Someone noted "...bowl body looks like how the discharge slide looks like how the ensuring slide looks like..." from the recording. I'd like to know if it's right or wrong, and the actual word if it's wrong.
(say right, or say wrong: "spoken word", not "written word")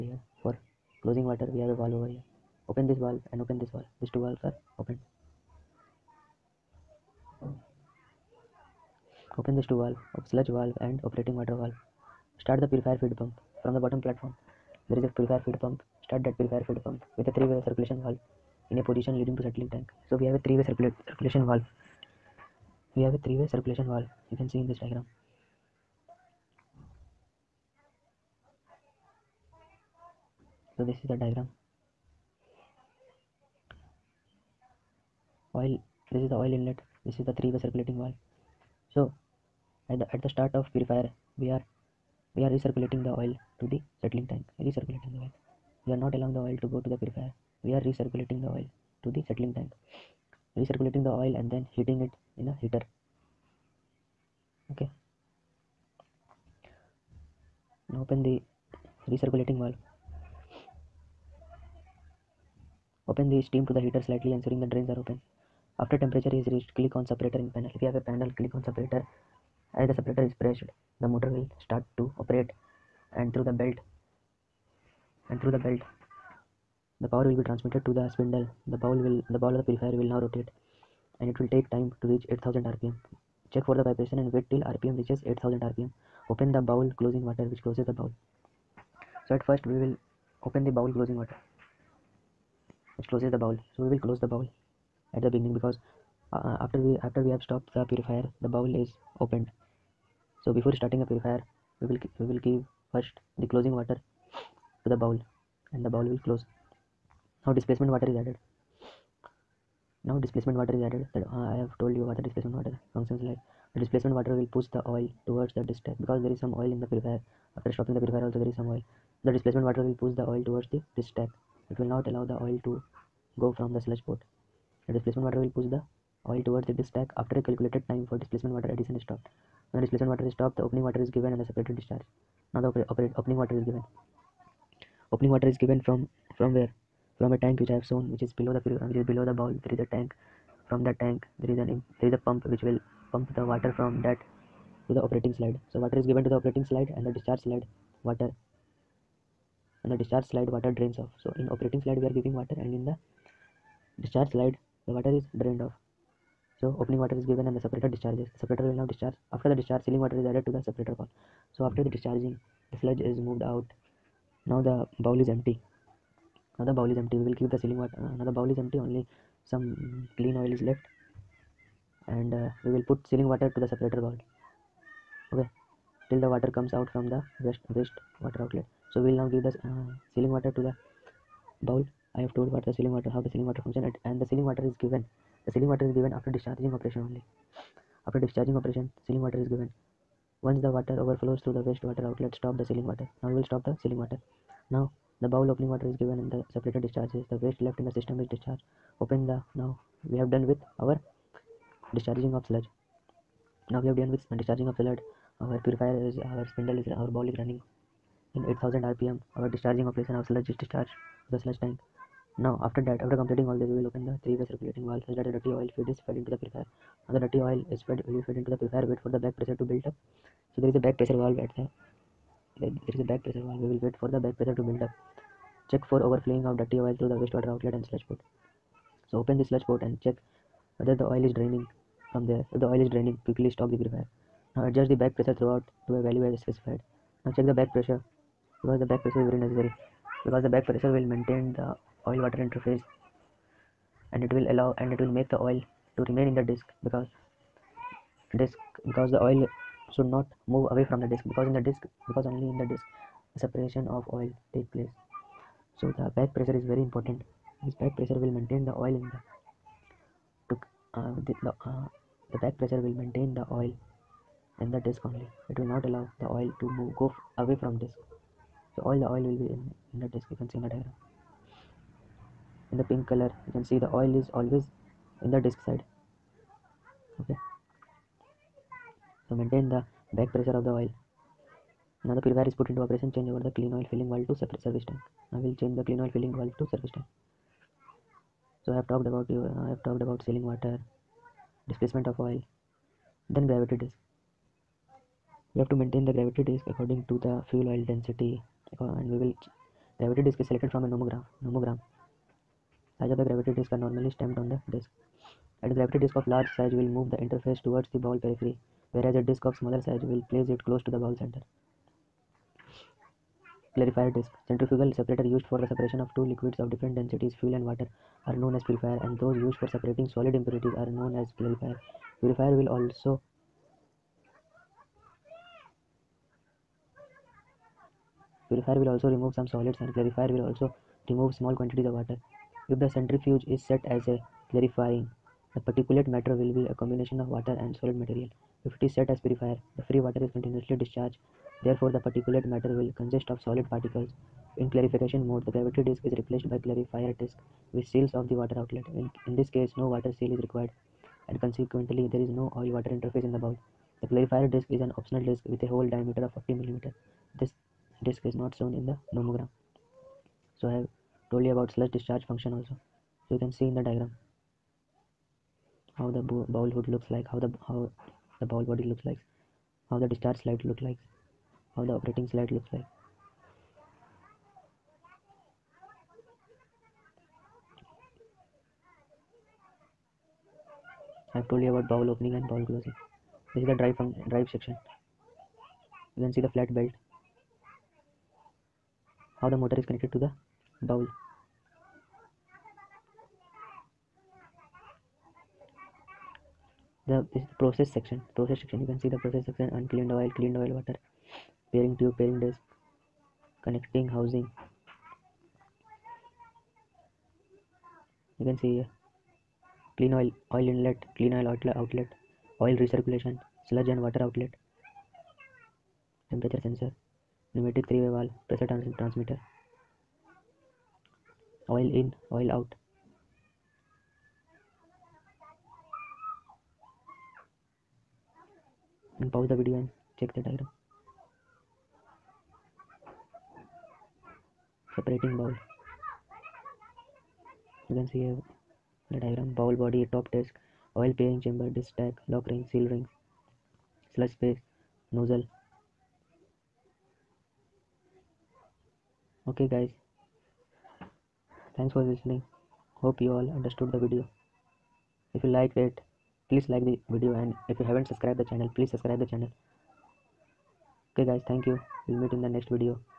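wrong: "operating", not "ensuring".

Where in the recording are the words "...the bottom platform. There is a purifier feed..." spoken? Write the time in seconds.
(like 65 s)
13 s.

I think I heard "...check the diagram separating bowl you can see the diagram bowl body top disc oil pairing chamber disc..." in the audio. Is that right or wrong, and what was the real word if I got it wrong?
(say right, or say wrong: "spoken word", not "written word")
right.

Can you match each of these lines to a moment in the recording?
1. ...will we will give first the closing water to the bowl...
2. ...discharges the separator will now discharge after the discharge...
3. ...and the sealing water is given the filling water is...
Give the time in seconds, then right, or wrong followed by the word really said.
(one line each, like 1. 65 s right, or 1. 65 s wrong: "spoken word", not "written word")
1. 101 s right
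2. 157 s right
3. 184 s wrong: "sealing", not "filling".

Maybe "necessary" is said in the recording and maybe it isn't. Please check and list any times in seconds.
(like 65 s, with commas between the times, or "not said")
239 s.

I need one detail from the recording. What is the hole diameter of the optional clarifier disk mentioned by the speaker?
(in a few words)
50 mm.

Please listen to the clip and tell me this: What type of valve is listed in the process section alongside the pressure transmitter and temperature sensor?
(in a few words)
Pneumatic three-way valve.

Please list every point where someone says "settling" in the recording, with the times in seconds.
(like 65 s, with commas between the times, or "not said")
19 s, 44 s, 49 s.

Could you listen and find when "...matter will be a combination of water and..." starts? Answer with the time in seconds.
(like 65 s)
336 s.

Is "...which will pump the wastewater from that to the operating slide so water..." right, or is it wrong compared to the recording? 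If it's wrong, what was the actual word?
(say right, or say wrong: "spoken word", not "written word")
wrong: "water", not "wastewater".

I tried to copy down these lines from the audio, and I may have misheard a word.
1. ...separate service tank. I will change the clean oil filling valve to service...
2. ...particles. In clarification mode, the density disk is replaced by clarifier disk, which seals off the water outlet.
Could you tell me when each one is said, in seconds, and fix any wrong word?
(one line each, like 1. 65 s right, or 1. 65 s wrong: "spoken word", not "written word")
1. 284 s right
2. 343 s wrong: "gravity", not "density".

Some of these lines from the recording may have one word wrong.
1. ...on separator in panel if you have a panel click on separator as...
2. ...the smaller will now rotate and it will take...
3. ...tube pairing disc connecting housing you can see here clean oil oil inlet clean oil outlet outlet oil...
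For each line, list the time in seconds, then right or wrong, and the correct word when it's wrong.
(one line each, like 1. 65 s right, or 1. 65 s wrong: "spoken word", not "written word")
1. 66 s right
2. 79 s wrong: "purifier", not "smaller"
3. 401 s right.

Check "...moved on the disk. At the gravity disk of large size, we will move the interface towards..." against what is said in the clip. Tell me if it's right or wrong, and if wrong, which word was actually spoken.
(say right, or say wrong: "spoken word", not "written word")
wrong: "stamped", not "moved".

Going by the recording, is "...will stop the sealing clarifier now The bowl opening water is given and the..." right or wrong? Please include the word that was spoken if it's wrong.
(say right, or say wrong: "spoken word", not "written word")
wrong: "water", not "clarifier".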